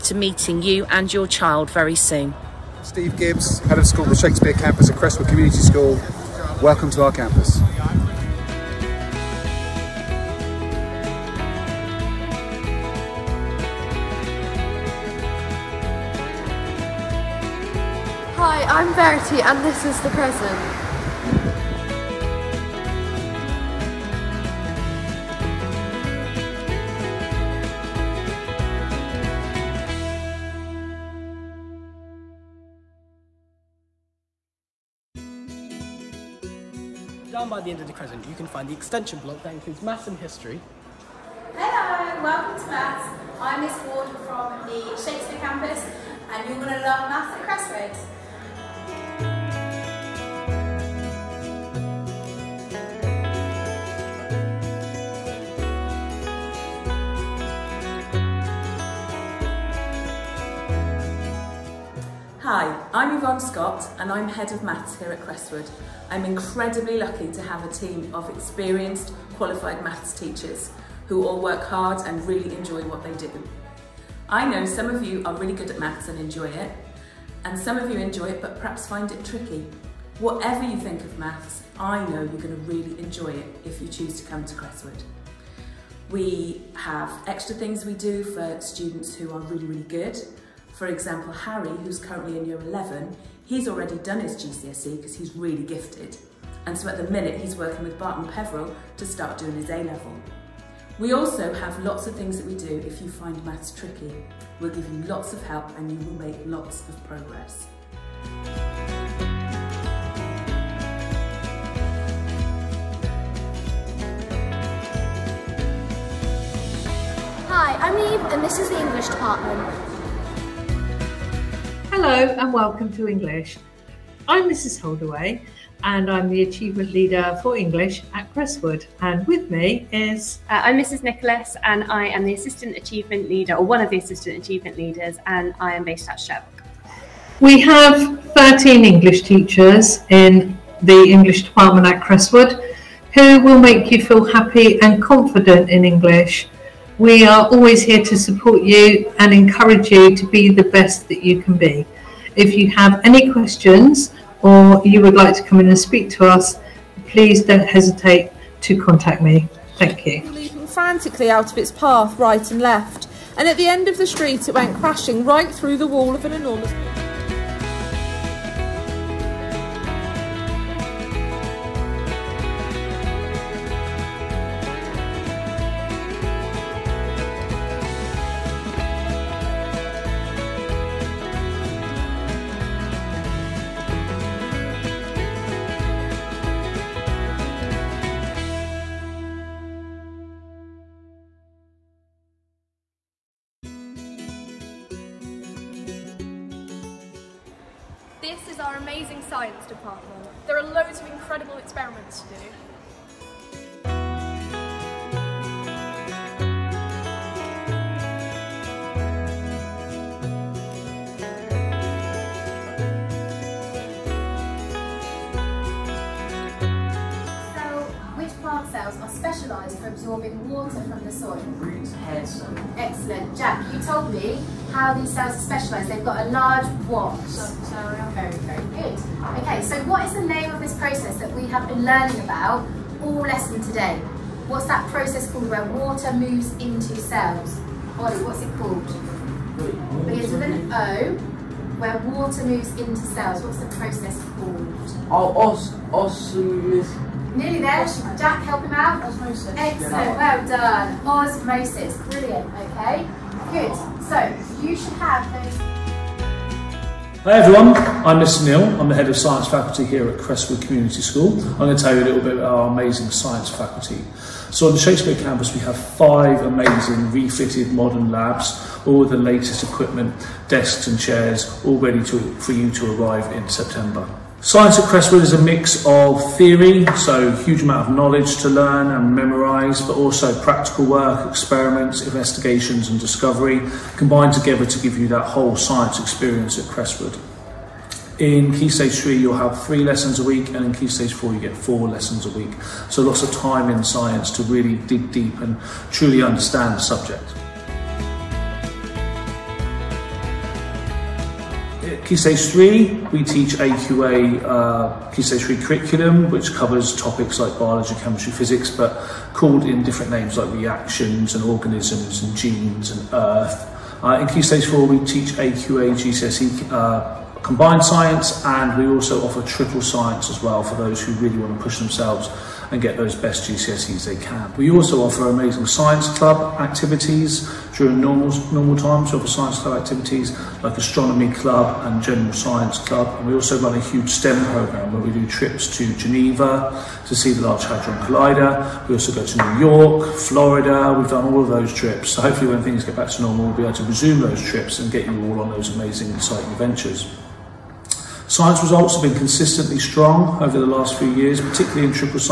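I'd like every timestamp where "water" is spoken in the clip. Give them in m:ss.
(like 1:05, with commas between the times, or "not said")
3:40, 3:55, 4:01.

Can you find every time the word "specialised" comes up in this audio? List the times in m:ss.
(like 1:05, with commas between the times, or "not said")
3:39, 3:45.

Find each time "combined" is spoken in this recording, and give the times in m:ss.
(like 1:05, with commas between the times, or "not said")
4:43, 5:17.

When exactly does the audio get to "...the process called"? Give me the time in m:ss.
4:03.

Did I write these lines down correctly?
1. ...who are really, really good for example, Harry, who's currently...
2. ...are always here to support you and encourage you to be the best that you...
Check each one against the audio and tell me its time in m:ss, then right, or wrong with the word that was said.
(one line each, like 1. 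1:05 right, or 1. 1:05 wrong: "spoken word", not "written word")
1. 1:29 right
2. 2:27 right.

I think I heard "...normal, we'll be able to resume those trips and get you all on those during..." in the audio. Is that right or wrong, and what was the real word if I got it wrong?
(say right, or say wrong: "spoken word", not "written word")
wrong: "amazing", not "during".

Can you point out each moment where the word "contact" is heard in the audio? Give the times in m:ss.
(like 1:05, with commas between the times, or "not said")
2:38.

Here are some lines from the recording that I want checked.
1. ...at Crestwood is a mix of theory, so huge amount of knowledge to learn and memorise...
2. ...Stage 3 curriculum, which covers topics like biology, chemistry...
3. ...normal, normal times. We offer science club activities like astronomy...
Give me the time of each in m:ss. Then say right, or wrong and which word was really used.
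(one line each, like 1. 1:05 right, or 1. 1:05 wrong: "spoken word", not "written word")
1. 4:34 right
2. 5:05 right
3. 5:28 right.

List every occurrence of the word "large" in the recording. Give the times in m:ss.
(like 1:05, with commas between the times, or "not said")
3:46, 5:37.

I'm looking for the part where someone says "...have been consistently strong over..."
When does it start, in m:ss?
5:48.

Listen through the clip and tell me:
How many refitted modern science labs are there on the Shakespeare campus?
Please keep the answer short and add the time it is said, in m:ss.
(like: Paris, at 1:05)
5, at 4:25.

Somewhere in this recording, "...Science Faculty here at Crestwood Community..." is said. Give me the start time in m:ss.
4:19.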